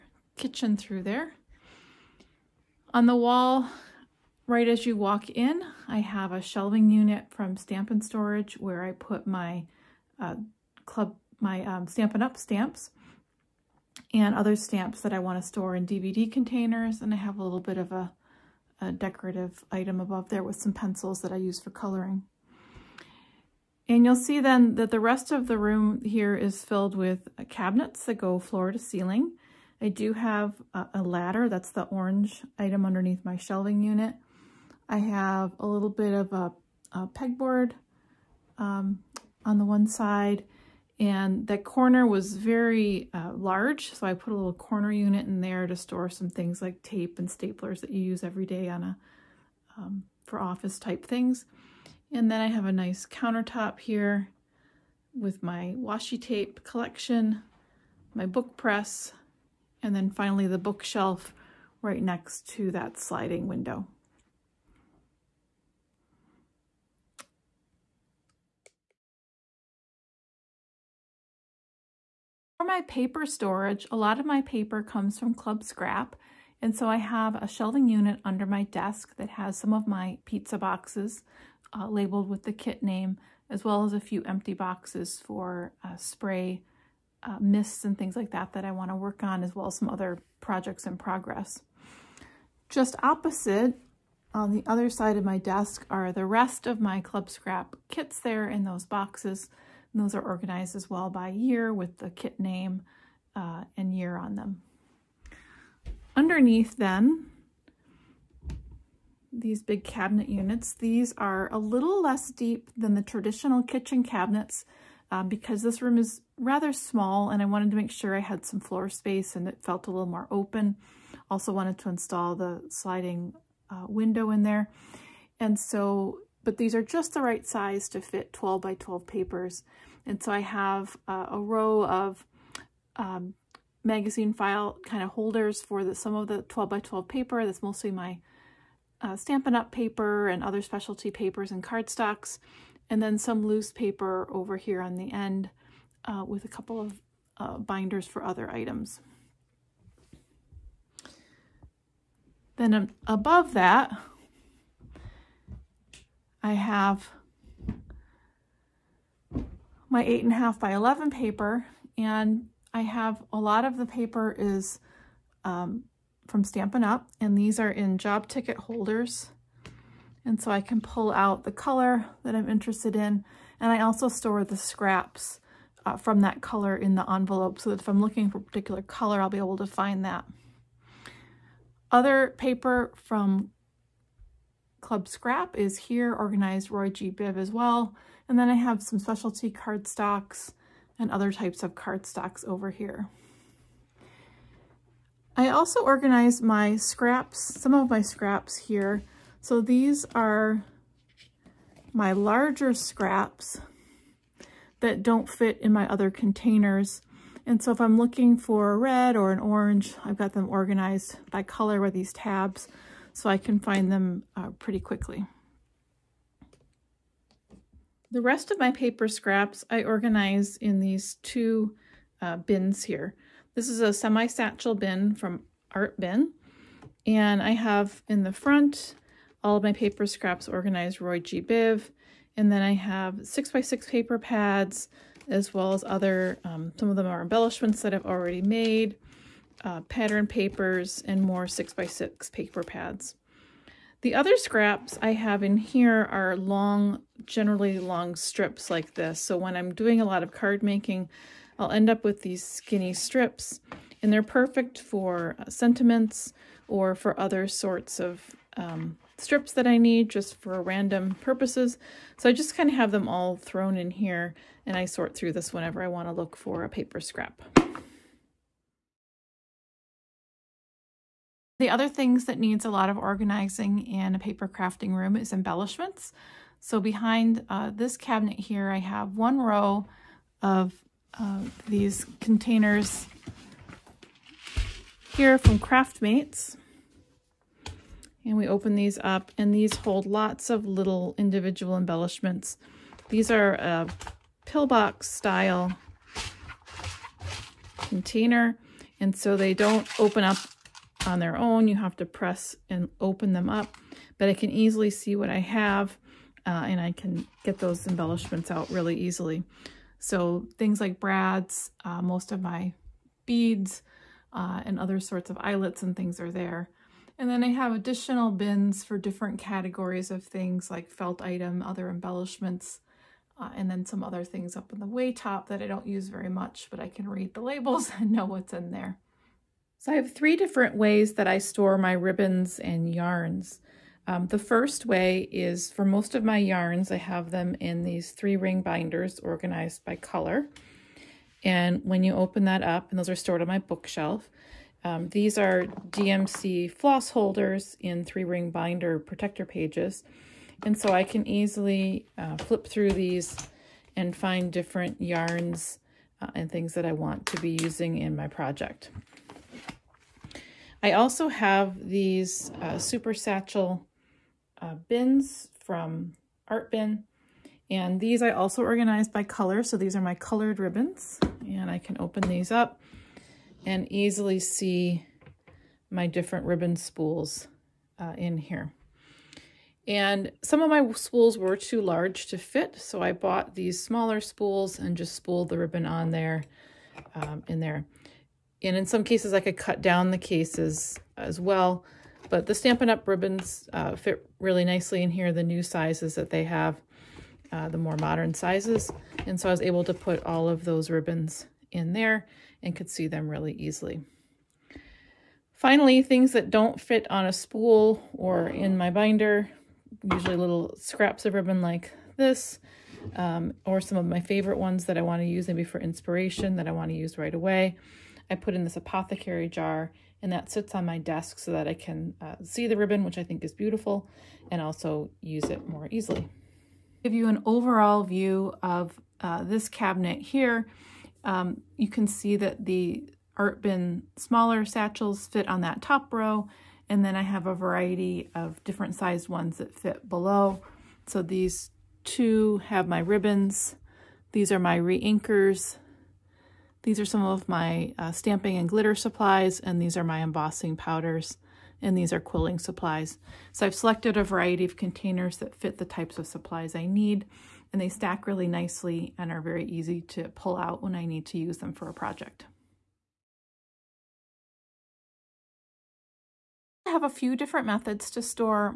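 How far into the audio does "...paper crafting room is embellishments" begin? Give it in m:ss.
4:34.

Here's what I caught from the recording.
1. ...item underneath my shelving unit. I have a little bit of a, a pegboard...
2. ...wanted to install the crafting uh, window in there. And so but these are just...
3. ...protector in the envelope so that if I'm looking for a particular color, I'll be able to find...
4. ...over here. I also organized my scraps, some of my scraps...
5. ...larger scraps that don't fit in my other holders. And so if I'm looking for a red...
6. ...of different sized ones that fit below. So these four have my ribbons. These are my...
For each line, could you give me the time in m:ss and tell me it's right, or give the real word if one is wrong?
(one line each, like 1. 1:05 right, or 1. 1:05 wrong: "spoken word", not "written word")
1. 0:32 right
2. 2:01 wrong: "sliding", not "crafting"
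3. 2:56 wrong: "color", not "protector"
4. 3:12 right
5. 3:22 wrong: "containers", not "holders"
6. 7:18 wrong: "two", not "four".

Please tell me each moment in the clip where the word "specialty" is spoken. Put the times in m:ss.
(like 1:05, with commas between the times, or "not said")
2:20, 3:08.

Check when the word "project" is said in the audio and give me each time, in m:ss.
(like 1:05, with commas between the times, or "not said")
1:30, 5:58, 7:41.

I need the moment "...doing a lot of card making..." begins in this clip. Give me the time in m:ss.
4:09.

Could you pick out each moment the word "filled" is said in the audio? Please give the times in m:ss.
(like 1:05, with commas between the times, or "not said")
0:26.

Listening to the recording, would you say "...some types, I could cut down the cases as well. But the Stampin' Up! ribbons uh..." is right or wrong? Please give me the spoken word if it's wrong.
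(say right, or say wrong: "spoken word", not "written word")
wrong: "cases", not "types".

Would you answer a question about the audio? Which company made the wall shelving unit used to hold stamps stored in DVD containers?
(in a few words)
Stamp-n-Storage.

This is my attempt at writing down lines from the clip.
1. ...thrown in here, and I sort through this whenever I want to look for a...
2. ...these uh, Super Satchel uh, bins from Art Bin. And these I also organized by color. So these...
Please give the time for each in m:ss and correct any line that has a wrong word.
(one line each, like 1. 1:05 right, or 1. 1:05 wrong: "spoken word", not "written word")
1. 4:23 right
2. 6:01 right.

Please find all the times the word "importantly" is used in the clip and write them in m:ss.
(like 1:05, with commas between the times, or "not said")
not said.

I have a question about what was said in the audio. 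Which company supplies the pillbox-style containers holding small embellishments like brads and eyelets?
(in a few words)
Craftmates.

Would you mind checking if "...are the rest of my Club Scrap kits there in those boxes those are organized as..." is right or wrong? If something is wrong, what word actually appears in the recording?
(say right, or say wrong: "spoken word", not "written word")
right.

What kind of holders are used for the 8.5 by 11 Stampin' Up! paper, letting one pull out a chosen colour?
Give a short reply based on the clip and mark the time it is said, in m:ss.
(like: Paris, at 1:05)
Job ticket holders, at 2:47.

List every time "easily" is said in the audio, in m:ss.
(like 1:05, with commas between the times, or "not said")
5:04, 5:08, 5:51, 6:13, 6:43, 7:05.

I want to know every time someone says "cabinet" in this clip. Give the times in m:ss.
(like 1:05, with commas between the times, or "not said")
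0:27, 1:49, 1:54, 4:37, 7:09.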